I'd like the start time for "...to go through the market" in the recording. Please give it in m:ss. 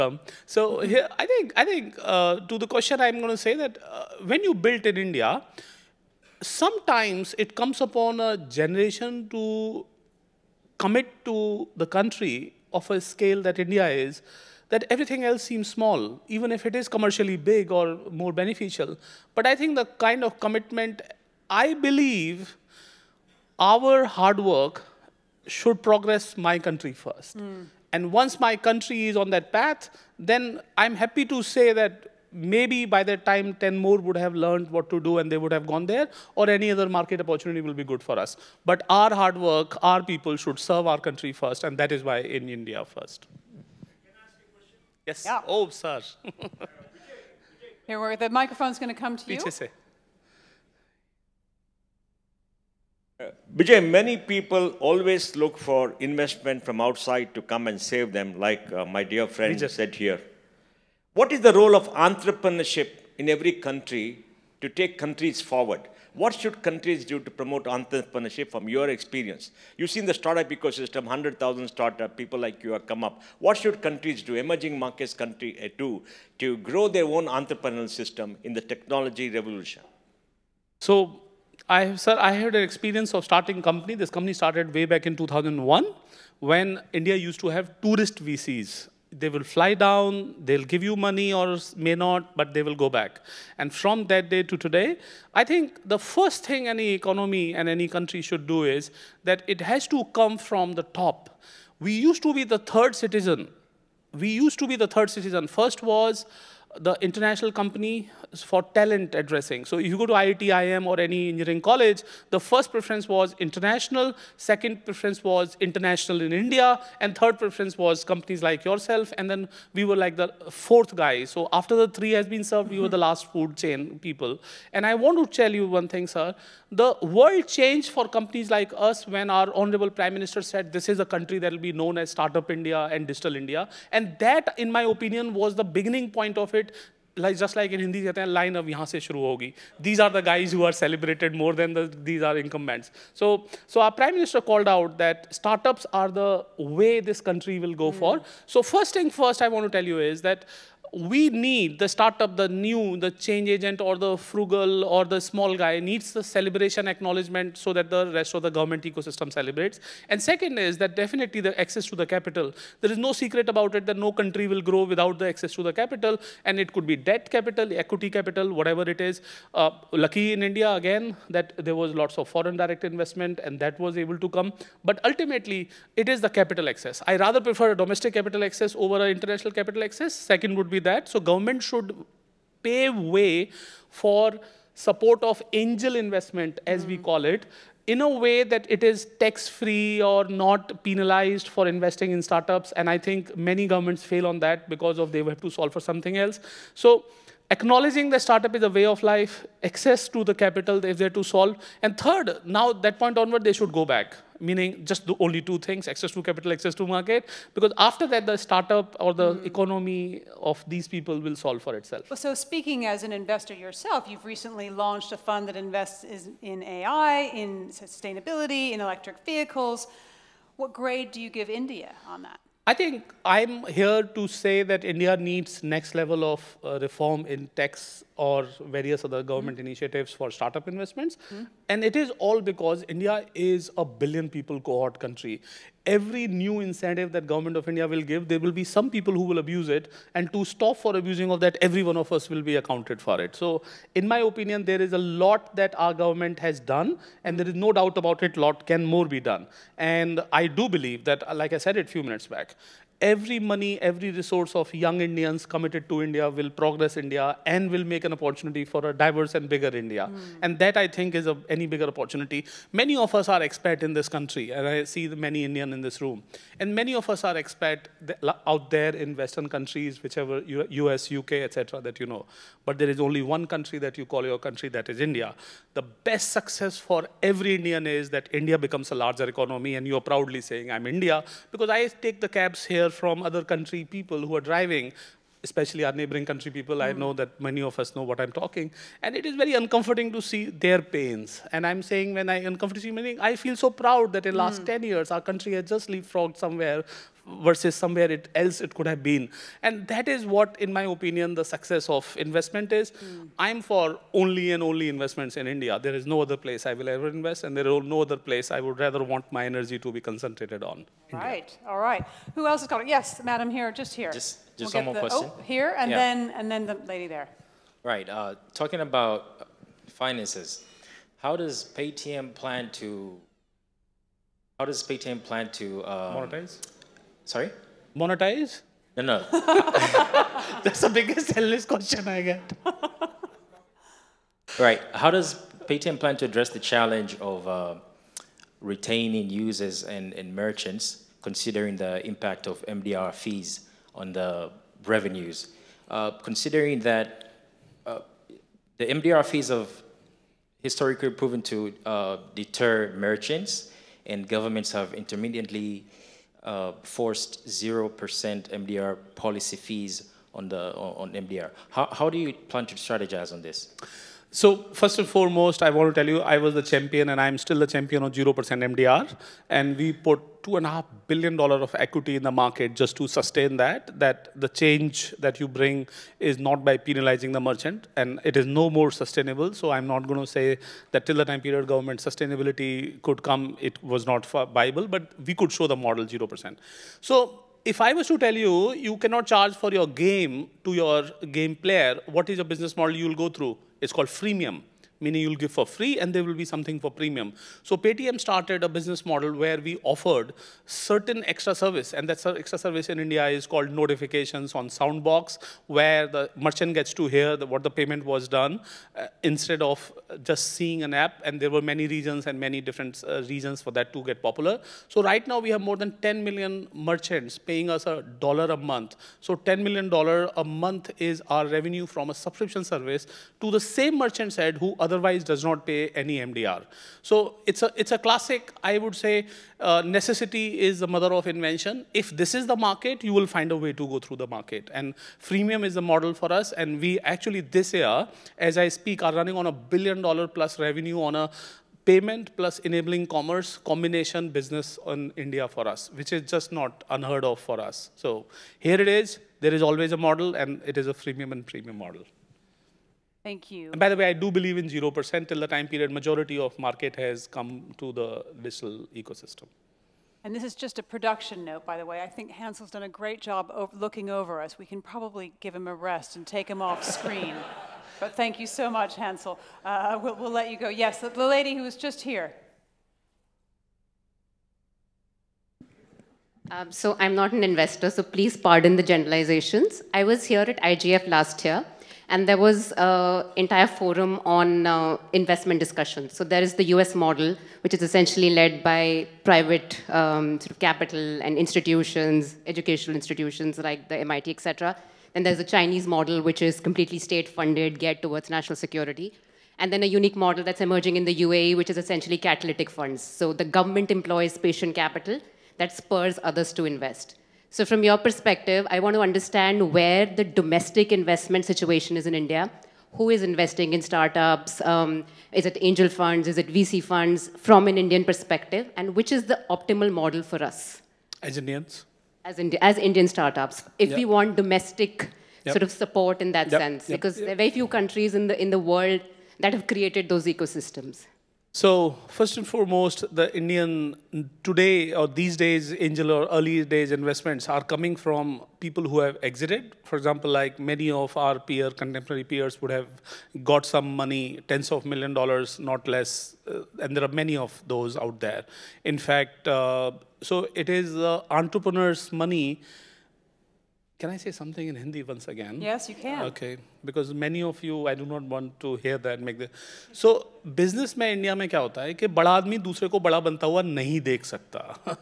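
7:13.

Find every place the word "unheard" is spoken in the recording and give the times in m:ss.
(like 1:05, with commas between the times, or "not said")
7:26.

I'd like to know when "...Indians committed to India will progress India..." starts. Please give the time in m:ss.
4:15.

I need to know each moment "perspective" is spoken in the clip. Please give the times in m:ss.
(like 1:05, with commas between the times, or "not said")
8:27, 8:38.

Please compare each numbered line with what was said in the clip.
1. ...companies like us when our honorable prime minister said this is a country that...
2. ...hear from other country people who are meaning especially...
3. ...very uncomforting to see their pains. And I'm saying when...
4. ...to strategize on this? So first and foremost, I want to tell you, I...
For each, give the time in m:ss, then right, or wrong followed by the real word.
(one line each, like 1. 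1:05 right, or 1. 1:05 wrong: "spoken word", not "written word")
1. 2:08 right
2. 4:42 wrong: "driving", not "meaning"
3. 4:49 right
4. 6:02 right.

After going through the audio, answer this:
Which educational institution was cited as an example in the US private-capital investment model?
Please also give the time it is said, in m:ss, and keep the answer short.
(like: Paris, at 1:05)
MIT, at 8:13.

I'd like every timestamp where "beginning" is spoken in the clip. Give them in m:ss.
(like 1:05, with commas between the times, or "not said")
2:15.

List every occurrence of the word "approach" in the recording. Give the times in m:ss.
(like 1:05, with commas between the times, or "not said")
not said.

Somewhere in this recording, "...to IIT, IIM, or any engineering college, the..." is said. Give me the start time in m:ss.
1:50.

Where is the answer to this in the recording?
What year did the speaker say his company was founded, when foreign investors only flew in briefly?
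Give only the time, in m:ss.
1:25.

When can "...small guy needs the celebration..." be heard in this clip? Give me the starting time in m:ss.
2:35.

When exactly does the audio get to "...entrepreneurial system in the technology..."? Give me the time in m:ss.
1:17.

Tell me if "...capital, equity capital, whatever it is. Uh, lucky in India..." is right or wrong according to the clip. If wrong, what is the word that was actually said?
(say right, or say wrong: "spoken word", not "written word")
right.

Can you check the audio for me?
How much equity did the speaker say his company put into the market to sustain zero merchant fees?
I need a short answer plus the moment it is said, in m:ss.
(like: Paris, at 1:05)
$2.5 billion, at 6:10.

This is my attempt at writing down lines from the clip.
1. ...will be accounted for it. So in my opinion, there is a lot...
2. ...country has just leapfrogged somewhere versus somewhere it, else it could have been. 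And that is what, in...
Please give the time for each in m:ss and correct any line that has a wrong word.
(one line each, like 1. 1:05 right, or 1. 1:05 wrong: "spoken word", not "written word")
1. 4:02 right
2. 4:55 right.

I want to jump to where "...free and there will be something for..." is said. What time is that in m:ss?
6:35.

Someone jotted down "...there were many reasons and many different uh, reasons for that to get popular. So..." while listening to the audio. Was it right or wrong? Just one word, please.
right.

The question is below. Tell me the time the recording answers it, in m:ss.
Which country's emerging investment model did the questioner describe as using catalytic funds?
8:21.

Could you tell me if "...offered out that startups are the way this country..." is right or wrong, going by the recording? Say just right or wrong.
wrong.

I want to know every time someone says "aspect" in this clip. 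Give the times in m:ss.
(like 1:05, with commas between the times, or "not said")
not said.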